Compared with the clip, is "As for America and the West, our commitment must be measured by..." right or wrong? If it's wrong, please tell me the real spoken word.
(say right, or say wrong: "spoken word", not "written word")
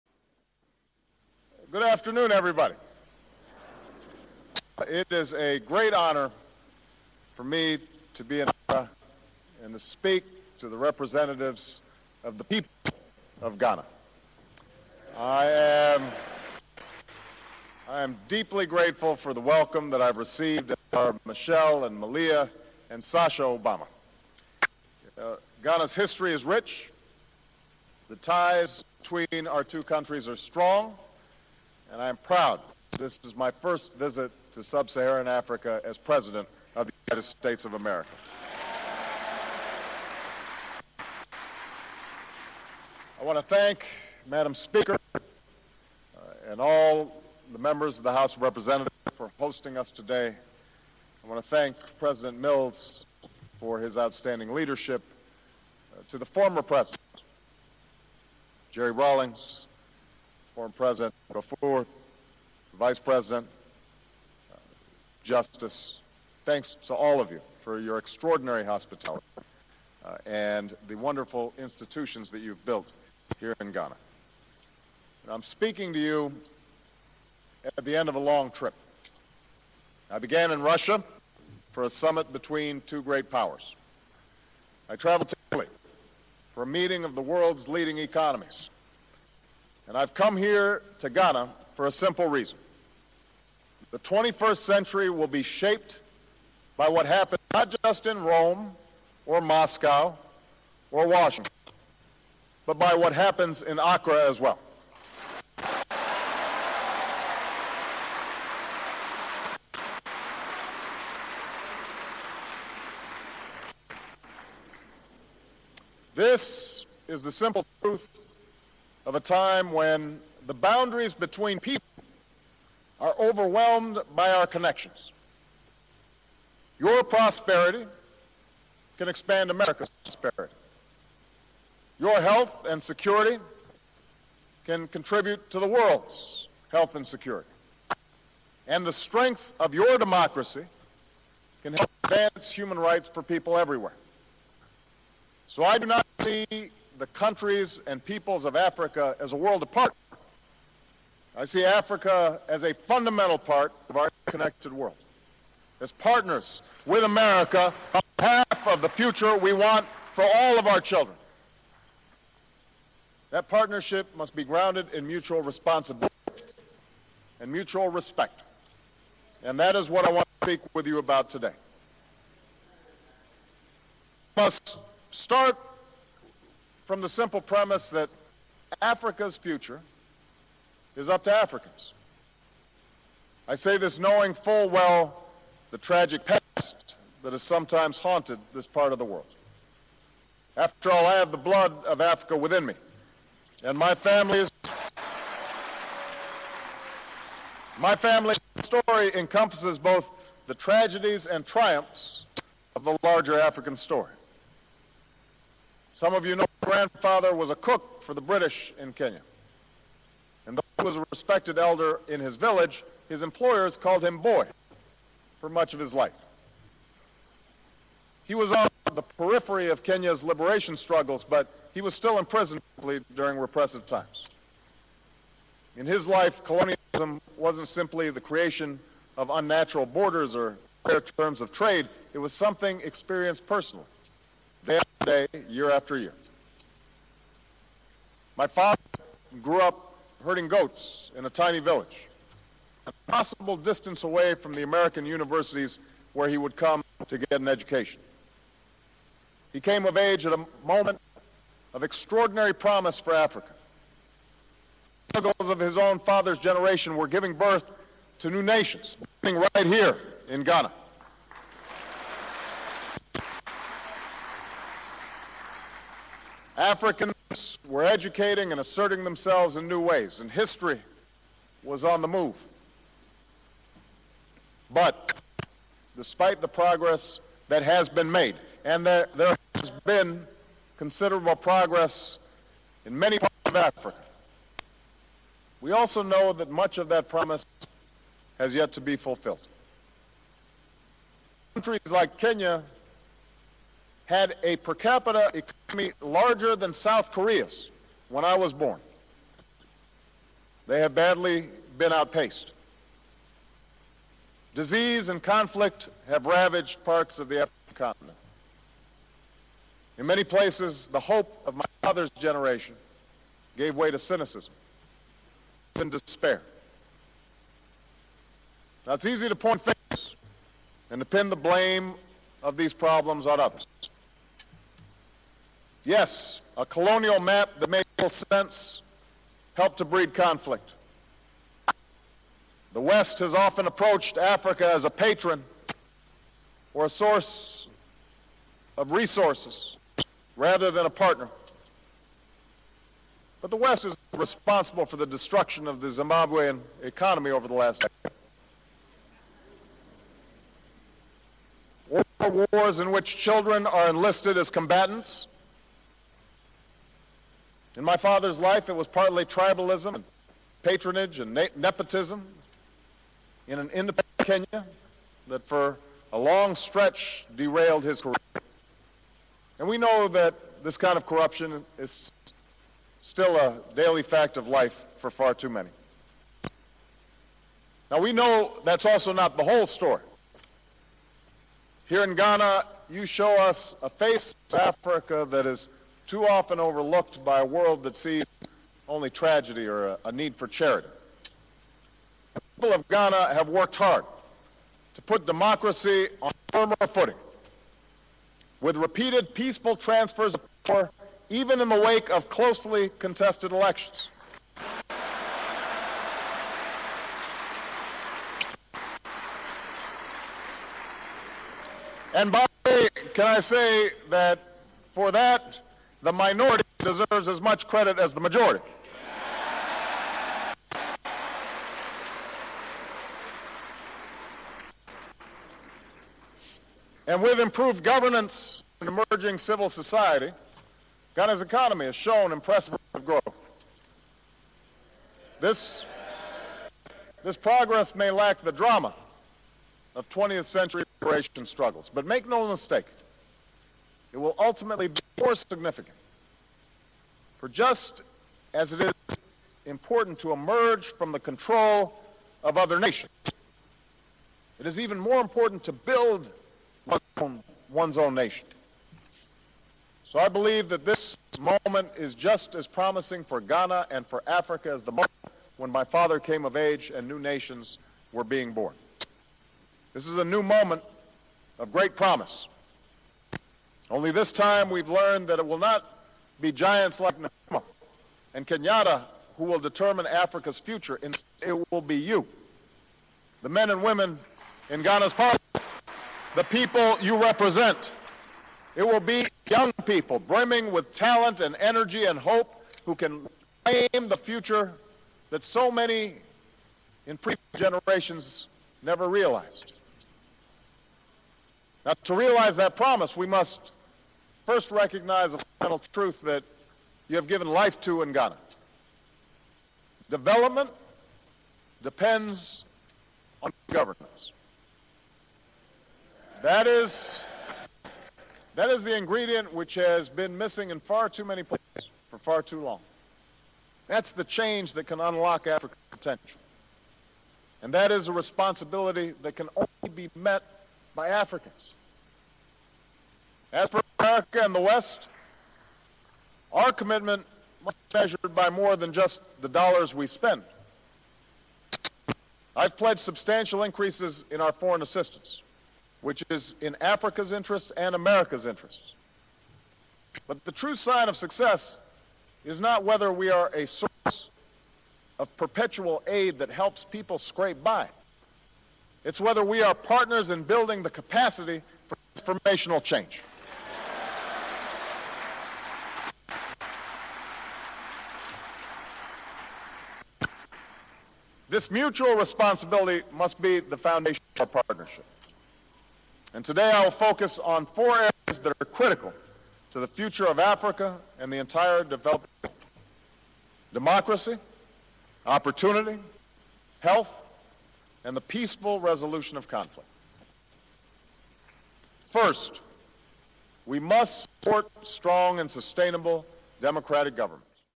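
right.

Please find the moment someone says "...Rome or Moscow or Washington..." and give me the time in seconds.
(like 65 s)
98 s.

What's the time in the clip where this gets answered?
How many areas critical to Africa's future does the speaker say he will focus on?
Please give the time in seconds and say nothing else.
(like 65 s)
577 s.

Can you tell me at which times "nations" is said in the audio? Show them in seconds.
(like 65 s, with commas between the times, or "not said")
258 s, 452 s, 458 s, 467 s.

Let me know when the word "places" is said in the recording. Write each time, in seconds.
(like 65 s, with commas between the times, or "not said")
310 s, 521 s.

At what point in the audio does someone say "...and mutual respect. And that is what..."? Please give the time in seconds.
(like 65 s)
167 s.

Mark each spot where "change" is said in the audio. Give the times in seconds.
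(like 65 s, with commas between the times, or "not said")
524 s, 562 s.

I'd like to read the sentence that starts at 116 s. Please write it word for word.
This is the simple truth of a time when the boundaries between people are overwhelmed by our connections.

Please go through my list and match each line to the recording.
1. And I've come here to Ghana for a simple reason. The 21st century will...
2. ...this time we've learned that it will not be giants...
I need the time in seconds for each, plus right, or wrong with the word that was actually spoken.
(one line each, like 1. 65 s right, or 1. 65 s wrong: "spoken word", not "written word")
1. 89 s right
2. 474 s right.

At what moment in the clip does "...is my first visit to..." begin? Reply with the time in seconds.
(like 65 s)
33 s.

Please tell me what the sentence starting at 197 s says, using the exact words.
My family's story encompasses both the tragedies and triumphs of the larger African story.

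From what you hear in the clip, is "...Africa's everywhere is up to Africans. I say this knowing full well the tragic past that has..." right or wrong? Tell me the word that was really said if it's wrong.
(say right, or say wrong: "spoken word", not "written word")
wrong: "future", not "everywhere".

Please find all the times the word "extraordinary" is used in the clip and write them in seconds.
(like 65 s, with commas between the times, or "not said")
67 s, 251 s.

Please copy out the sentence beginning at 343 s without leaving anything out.
But the West is responsible for the destruction of the Zimbabwean economy over the last decade.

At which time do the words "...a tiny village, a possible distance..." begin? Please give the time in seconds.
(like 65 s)
241 s.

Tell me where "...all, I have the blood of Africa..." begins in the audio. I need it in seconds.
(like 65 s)
190 s.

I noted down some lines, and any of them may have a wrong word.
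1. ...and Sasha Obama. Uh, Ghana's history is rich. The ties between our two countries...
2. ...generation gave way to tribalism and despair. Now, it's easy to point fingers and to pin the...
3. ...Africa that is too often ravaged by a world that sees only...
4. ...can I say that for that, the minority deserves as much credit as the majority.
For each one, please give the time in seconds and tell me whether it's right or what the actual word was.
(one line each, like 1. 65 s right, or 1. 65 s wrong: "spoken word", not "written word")
1. 22 s right
2. 312 s wrong: "cynicism", not "tribalism"
3. 384 s wrong: "overlooked", not "ravaged"
4. 413 s right.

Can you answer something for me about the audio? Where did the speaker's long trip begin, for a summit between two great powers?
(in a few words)
Russia.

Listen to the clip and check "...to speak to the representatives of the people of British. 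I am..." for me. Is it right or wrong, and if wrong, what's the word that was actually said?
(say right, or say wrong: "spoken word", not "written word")
wrong: "Ghana", not "British".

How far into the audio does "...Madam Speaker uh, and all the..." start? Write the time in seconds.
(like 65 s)
44 s.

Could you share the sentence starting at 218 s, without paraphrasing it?
He was on the periphery of Kenya's liberation struggles, but he was still imprisoned during repressive times.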